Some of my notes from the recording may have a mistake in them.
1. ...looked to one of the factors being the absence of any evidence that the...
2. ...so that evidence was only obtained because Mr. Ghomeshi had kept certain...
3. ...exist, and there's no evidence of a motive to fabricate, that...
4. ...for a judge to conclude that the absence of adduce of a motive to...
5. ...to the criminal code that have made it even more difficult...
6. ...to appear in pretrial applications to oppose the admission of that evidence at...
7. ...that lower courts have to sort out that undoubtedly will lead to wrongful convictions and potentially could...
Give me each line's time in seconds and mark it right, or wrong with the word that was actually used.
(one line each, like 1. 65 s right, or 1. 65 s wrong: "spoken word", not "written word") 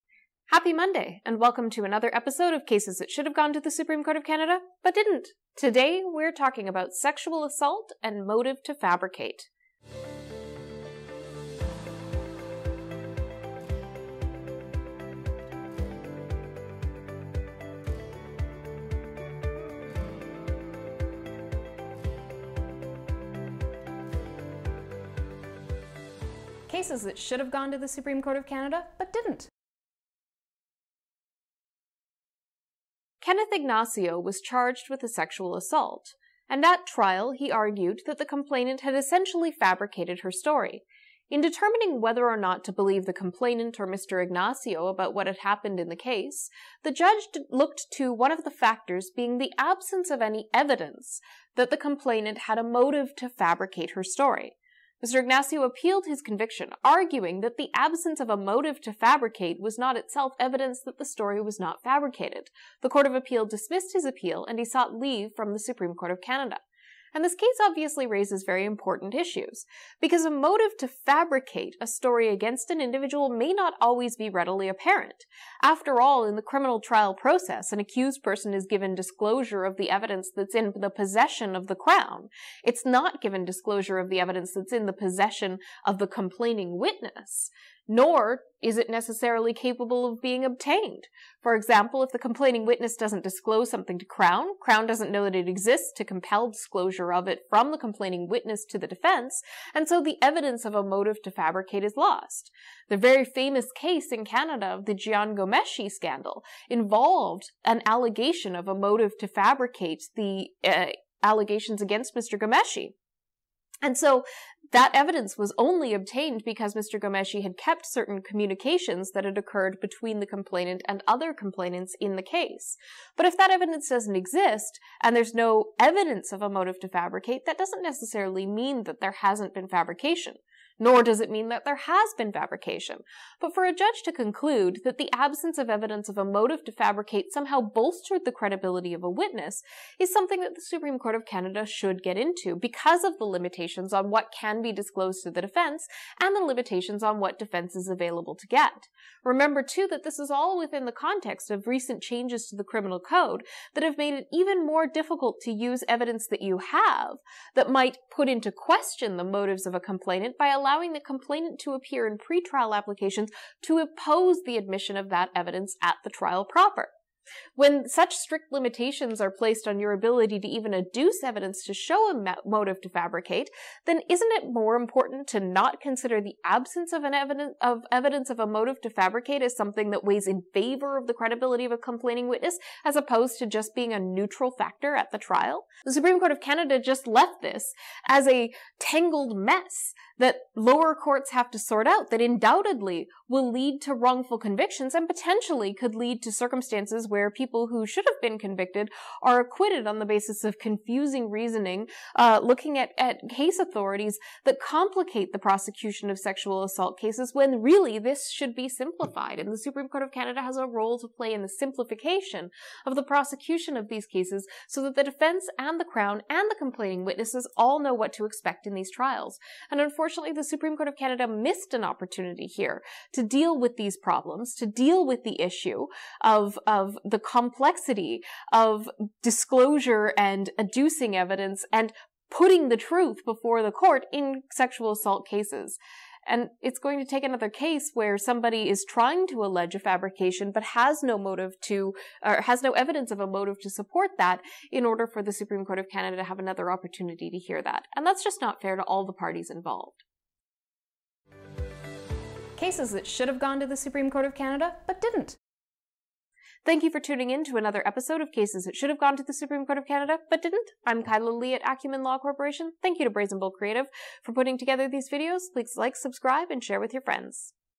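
1. 47 s right
2. 113 s right
3. 124 s right
4. 133 s wrong: "evidence", not "adduce"
5. 152 s right
6. 161 s right
7. 190 s right.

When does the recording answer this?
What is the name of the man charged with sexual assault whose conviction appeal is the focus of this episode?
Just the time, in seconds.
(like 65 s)
33 s.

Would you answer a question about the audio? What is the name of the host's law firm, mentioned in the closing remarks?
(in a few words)
Acumen Law Corporation.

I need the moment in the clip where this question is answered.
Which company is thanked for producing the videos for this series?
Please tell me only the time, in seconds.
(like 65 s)
263 s.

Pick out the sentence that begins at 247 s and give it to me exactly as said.
And that's just not fair to all the parties involved.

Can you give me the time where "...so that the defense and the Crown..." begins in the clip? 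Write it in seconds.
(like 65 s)
214 s.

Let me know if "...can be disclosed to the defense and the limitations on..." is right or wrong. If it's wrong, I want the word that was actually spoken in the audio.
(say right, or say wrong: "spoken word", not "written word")
right.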